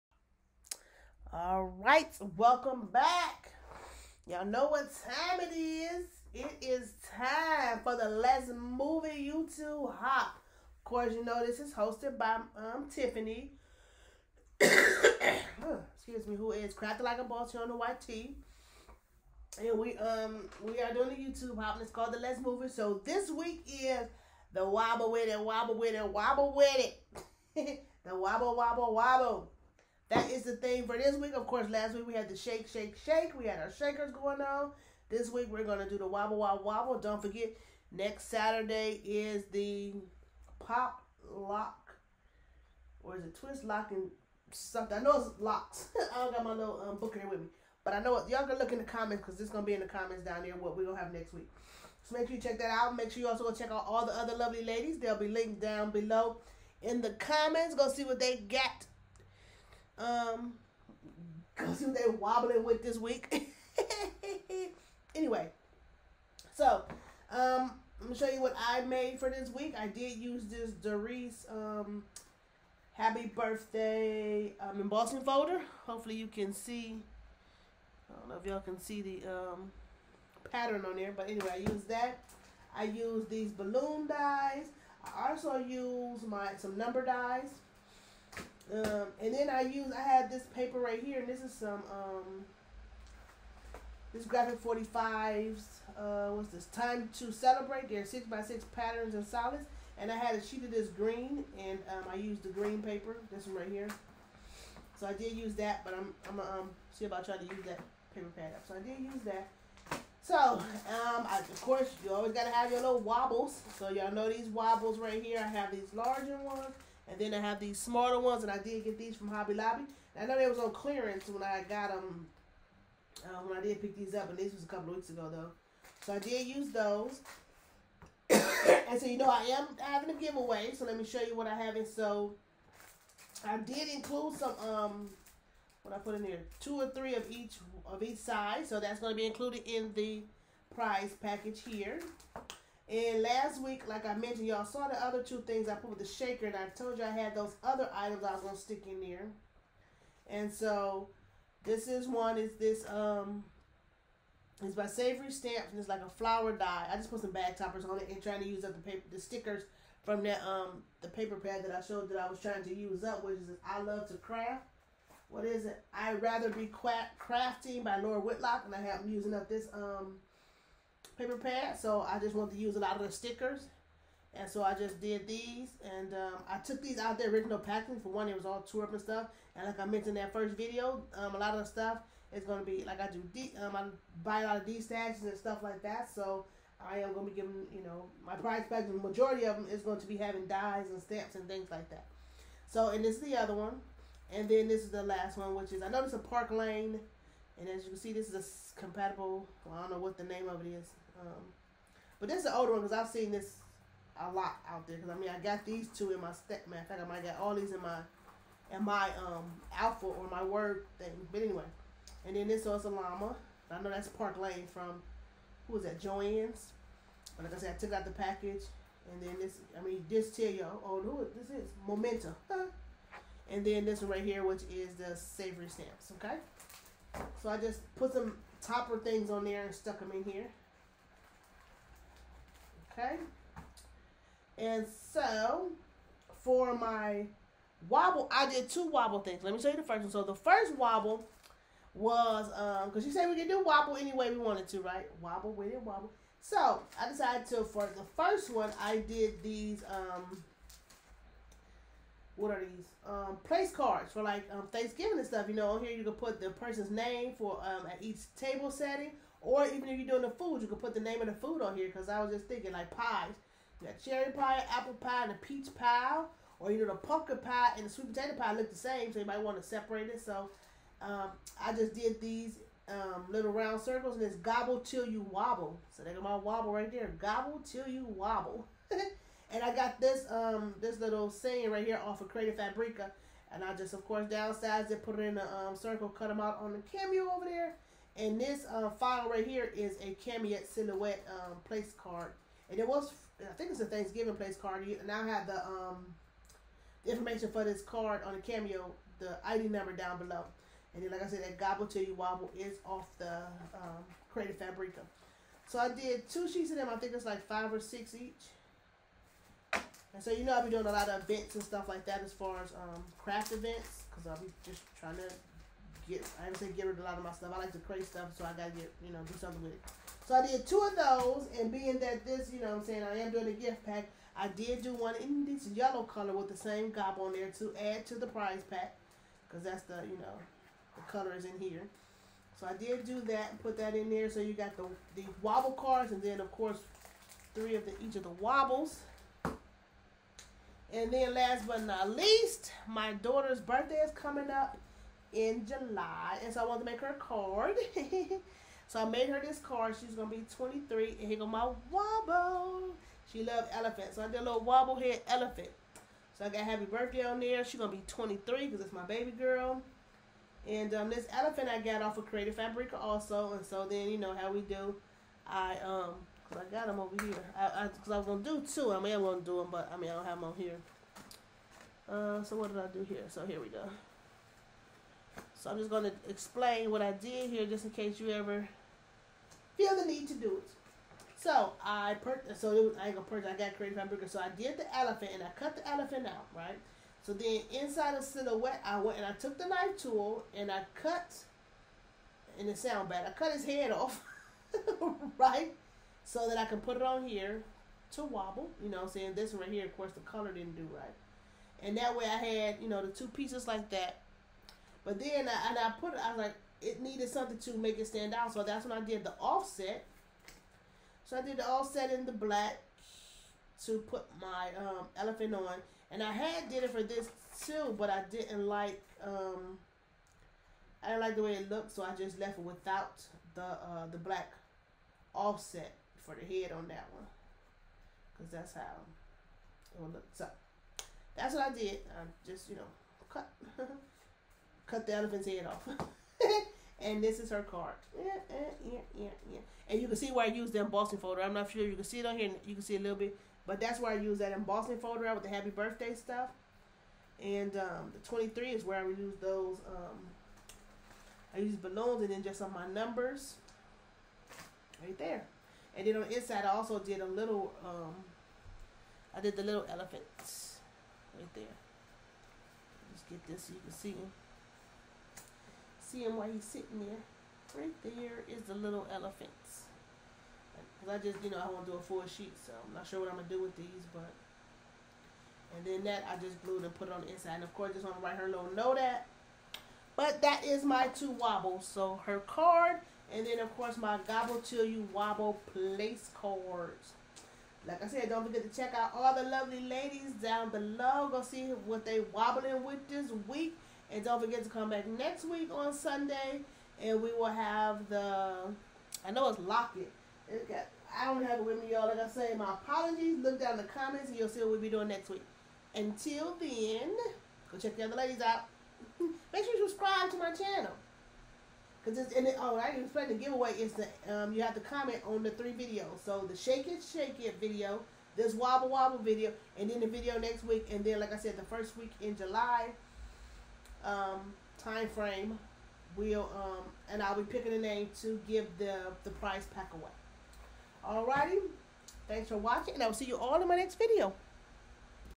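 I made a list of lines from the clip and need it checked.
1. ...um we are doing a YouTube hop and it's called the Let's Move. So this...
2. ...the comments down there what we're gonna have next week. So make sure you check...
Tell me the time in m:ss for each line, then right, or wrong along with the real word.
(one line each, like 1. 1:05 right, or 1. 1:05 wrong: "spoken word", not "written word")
1. 0:19 right
2. 0:49 right.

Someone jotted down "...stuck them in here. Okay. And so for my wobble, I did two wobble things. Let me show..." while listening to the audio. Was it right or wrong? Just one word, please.
right.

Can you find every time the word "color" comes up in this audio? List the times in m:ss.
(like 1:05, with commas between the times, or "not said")
5:26, 5:31, 6:40.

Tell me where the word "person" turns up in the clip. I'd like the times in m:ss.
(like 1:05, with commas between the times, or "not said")
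4:16.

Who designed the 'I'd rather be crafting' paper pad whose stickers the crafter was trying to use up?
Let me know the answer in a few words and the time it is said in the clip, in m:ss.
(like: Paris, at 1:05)
Lori Whitlock, at 2:48.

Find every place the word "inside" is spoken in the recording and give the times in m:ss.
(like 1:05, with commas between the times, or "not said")
6:27, 7:36, 7:57.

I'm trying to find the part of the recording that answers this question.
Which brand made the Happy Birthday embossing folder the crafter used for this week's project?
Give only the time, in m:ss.
1:10.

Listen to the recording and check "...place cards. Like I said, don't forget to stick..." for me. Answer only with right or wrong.
wrong.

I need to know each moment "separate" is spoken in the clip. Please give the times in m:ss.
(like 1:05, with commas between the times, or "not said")
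4:29.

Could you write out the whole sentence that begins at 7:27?
And um, the 23 is where I use those.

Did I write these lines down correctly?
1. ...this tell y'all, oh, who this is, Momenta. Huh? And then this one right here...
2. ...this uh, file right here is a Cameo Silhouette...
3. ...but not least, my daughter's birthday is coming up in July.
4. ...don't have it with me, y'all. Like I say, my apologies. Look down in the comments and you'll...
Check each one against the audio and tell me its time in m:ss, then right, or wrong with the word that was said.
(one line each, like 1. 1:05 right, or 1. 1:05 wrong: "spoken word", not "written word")
1. 3:40 right
2. 4:48 right
3. 5:41 right
4. 8:21 right.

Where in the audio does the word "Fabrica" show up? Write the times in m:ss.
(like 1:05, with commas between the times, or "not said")
4:42, 5:04, 6:02.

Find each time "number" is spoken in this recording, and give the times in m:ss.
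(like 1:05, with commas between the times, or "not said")
1:26, 4:59, 7:32.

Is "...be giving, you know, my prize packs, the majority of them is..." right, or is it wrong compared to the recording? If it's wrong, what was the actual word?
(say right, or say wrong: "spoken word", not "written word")
right.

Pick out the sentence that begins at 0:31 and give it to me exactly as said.
Of course, last week we had the shake, shake, shake.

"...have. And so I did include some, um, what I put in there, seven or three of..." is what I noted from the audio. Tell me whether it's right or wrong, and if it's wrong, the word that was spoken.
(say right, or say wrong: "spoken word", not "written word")
wrong: "two", not "seven".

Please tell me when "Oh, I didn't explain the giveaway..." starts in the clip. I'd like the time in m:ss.
8:32.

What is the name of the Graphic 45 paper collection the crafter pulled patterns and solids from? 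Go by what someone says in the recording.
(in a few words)
Time to celebrate.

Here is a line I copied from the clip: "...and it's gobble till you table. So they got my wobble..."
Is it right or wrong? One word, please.
wrong.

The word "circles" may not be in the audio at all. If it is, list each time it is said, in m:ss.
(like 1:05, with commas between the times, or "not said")
4:33, 4:45.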